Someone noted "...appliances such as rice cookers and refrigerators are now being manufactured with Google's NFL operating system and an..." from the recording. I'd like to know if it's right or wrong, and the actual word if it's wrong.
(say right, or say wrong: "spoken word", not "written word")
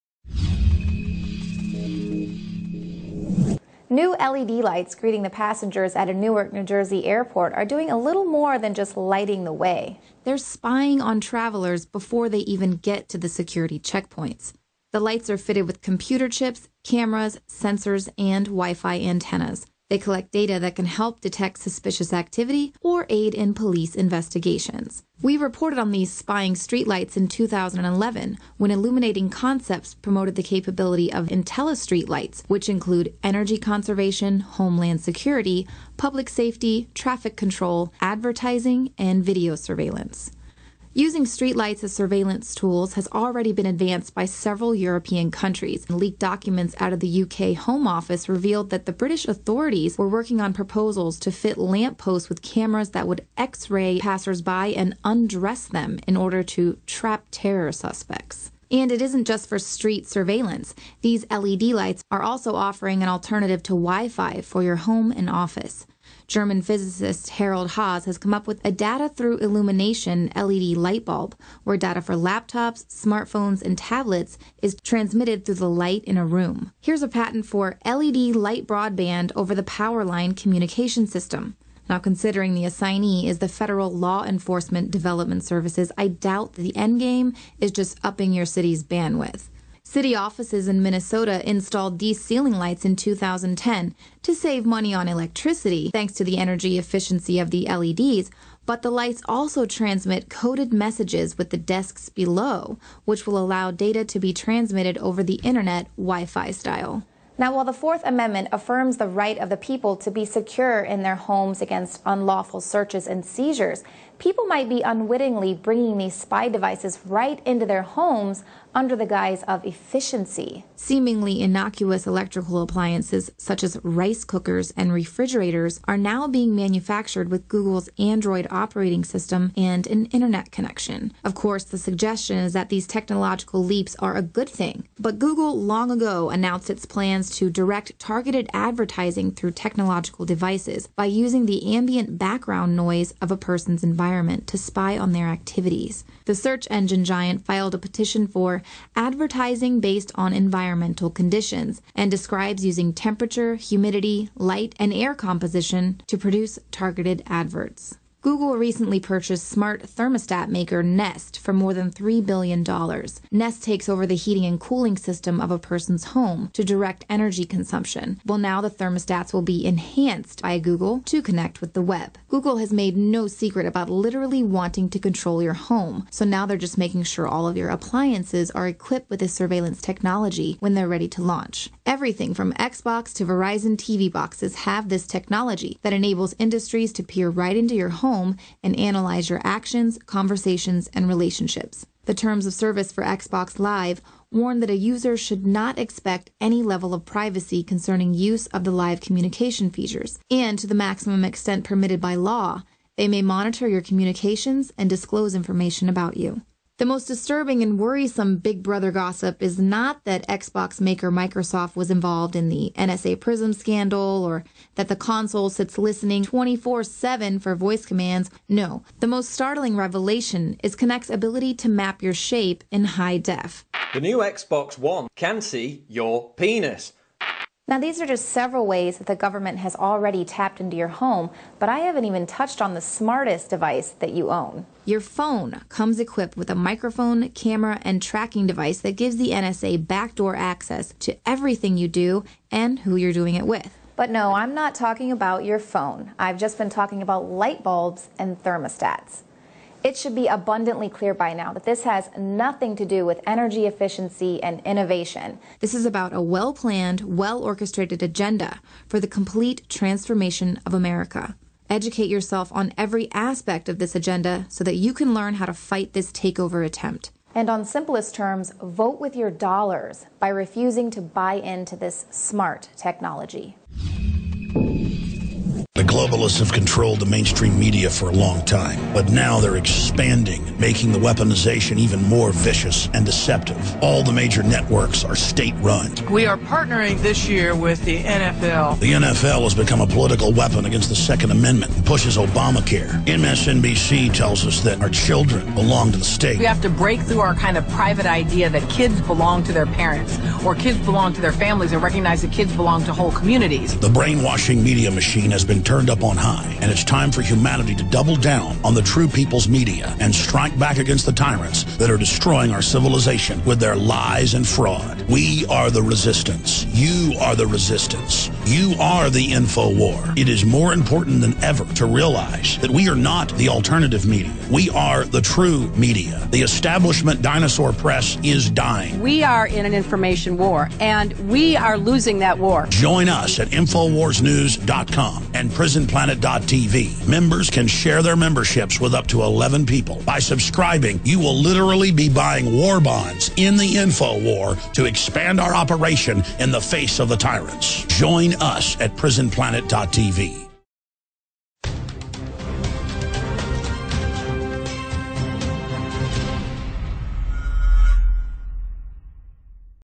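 wrong: "Android", not "NFL".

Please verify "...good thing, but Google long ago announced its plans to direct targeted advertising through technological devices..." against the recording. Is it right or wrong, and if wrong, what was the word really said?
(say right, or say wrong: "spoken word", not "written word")
right.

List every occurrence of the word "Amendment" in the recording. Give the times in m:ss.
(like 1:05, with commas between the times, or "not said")
1:48, 4:51.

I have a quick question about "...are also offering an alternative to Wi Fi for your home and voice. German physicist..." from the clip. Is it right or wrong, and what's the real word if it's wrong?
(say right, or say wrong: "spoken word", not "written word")
wrong: "office", not "voice".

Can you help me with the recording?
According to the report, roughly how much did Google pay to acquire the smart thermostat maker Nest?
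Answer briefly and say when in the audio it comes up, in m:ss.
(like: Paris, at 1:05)
more than $3 billion, at 2:41.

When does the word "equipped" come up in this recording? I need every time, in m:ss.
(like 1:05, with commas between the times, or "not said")
2:58, 3:55.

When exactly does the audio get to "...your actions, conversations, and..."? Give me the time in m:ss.
3:09.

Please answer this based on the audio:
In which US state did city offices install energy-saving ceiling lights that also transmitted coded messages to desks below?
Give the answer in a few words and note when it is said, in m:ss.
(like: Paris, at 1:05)
Minnesota, at 1:30.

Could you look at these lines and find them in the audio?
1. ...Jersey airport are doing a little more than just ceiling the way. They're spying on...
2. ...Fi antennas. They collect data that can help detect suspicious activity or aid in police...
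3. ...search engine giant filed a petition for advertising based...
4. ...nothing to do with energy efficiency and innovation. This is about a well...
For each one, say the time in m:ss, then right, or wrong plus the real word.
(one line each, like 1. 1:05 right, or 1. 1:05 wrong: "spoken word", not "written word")
1. 0:06 wrong: "lighting", not "ceiling"
2. 0:18 right
3. 2:26 right
4. 4:12 right.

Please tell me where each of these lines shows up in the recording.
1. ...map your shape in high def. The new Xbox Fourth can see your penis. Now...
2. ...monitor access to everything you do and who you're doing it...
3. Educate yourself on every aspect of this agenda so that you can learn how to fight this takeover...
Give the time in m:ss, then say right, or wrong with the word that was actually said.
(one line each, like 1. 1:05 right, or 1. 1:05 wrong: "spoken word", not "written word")
1. 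3:41 wrong: "One", not "Fourth"
2. 3:59 wrong: "backdoor", not "monitor"
3. 4:21 right.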